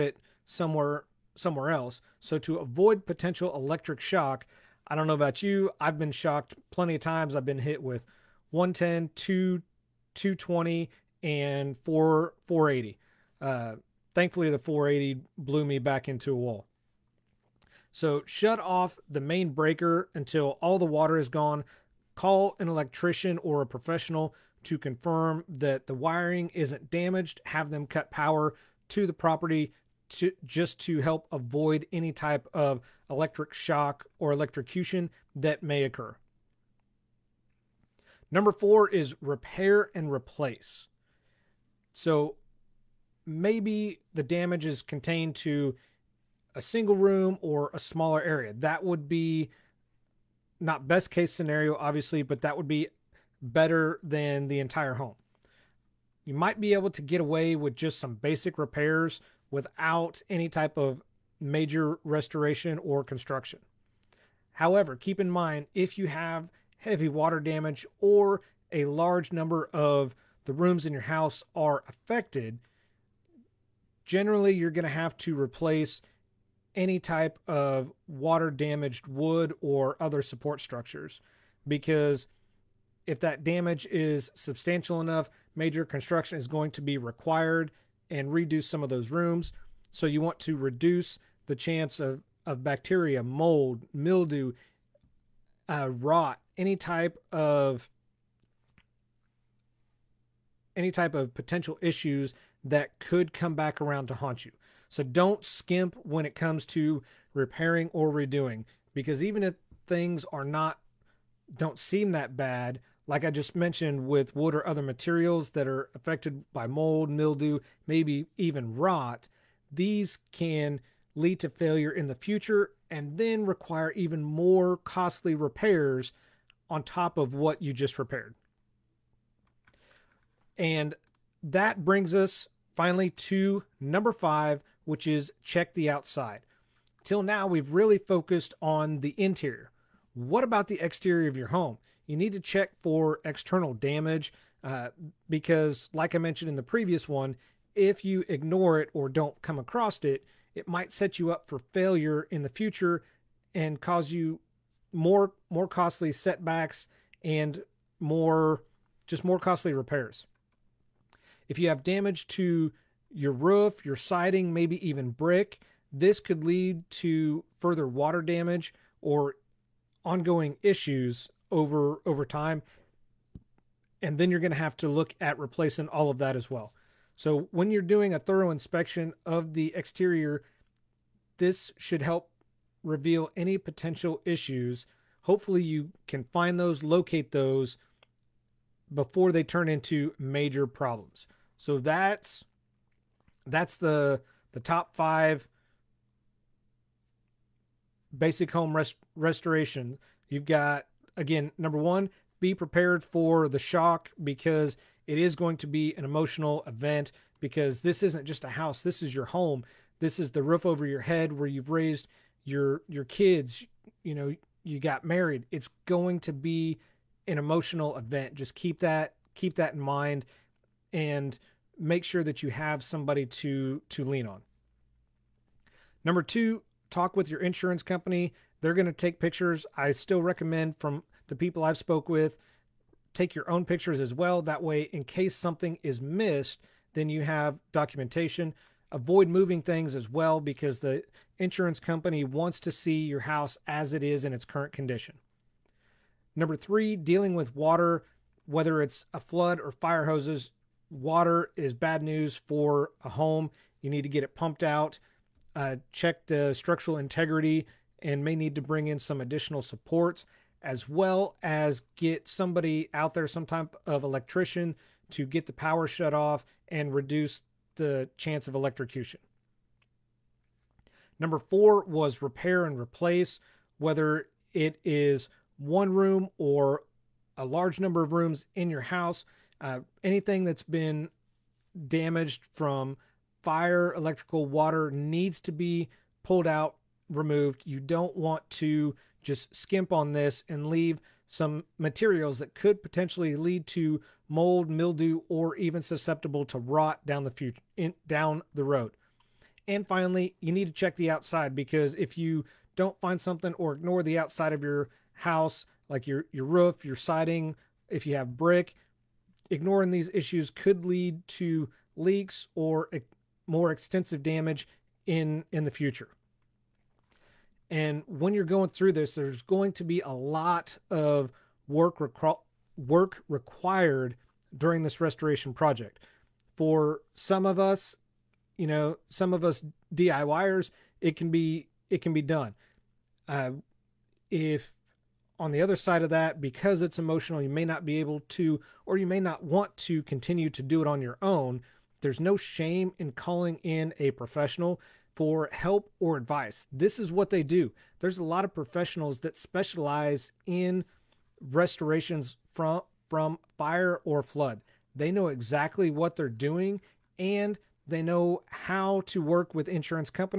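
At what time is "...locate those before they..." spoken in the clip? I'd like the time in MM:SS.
03:06.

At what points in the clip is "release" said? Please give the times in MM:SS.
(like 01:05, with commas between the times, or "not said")
not said.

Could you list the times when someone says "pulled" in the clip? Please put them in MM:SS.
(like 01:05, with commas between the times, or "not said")
04:46.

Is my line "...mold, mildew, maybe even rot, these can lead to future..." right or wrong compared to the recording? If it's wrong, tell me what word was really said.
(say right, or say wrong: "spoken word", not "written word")
wrong: "failure", not "future".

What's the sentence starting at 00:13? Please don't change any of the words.
Uh, thankfully, the 480 blew me back into a wall.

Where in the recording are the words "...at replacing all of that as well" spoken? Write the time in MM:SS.
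02:55.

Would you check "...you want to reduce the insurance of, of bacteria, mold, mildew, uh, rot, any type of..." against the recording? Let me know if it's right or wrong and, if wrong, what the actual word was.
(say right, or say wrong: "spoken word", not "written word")
wrong: "chance", not "insurance".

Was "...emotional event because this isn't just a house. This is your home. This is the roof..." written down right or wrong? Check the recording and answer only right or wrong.
right.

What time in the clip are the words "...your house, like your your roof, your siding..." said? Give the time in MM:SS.
05:04.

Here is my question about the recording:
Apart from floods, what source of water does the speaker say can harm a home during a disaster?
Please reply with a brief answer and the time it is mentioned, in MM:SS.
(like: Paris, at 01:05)
Fire hoses, at 04:09.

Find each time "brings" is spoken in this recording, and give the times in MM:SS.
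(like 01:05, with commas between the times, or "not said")
02:11, 04:18.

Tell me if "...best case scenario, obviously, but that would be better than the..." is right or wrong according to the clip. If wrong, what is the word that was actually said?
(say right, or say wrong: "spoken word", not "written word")
right.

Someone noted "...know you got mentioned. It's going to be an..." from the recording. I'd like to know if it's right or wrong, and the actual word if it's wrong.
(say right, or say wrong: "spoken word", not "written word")
wrong: "married", not "mentioned".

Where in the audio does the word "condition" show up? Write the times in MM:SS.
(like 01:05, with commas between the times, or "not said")
04:04.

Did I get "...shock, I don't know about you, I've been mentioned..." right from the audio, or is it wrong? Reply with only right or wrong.
wrong.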